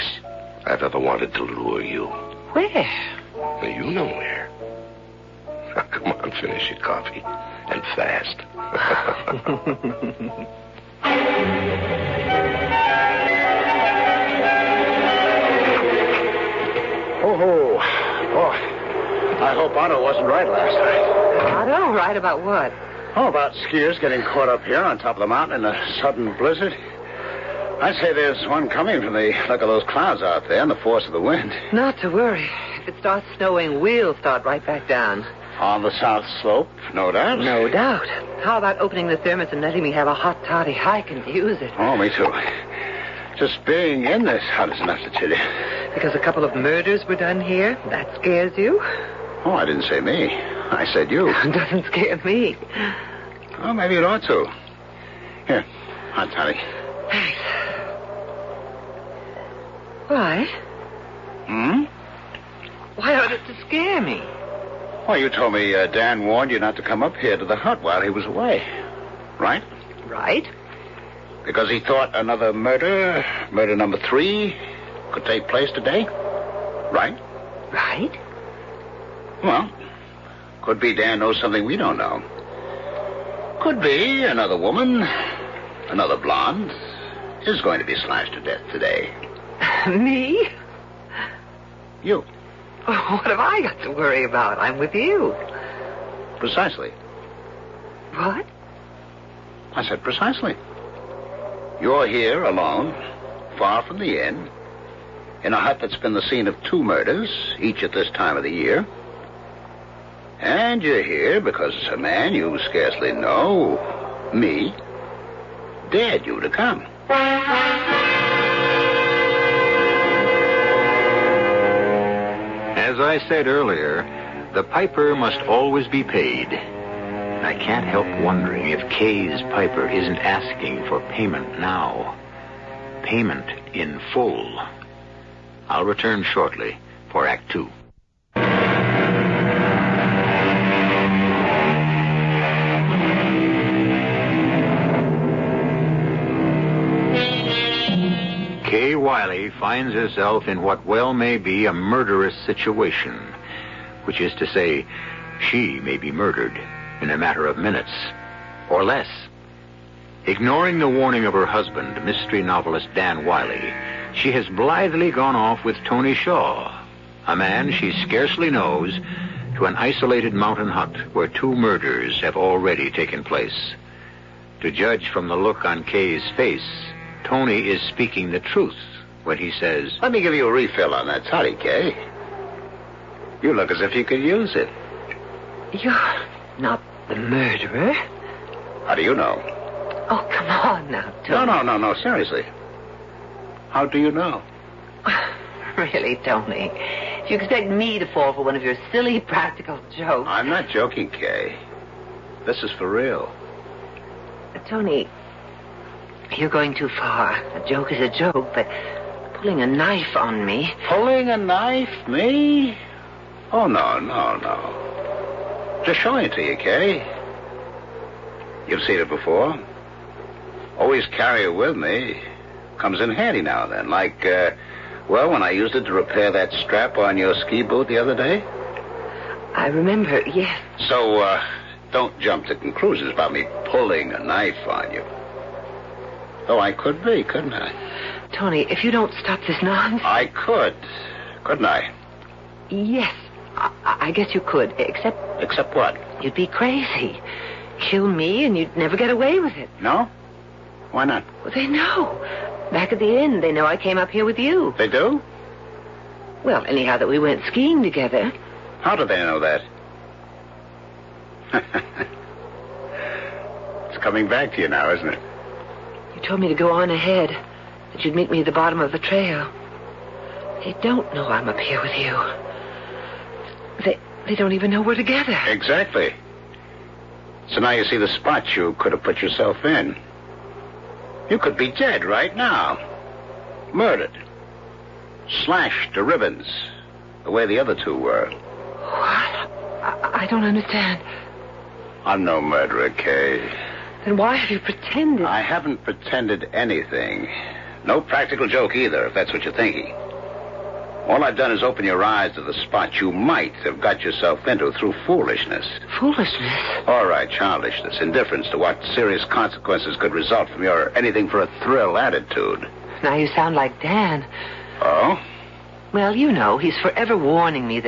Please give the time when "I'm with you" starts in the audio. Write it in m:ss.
1:34.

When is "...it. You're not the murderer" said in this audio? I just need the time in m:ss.
3:04.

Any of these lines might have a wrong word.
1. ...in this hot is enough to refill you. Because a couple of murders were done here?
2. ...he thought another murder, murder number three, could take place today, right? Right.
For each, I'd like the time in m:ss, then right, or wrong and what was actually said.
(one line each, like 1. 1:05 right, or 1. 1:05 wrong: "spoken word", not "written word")
1. 0:44 wrong: "chill", not "refill"
2. 1:11 right.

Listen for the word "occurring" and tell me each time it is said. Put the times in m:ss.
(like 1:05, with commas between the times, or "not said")
not said.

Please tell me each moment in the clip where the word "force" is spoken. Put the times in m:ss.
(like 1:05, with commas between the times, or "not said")
0:30.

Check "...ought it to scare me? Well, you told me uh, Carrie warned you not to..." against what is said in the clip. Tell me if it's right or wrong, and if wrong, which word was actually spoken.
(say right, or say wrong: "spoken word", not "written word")
wrong: "Dan", not "Carrie".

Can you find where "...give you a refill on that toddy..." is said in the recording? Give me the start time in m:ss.
3:00.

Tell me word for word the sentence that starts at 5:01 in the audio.
All I've done is open your eyes to the spot you might have got yourself into through foolishness.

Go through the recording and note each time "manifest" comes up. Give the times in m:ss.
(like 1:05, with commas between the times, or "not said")
not said.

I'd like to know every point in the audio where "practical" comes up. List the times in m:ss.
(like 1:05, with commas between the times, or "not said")
3:19, 4:58.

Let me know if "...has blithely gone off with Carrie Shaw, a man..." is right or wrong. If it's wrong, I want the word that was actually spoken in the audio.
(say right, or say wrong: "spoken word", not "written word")
wrong: "Tony", not "Carrie".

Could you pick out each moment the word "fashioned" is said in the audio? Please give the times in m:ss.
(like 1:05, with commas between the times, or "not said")
not said.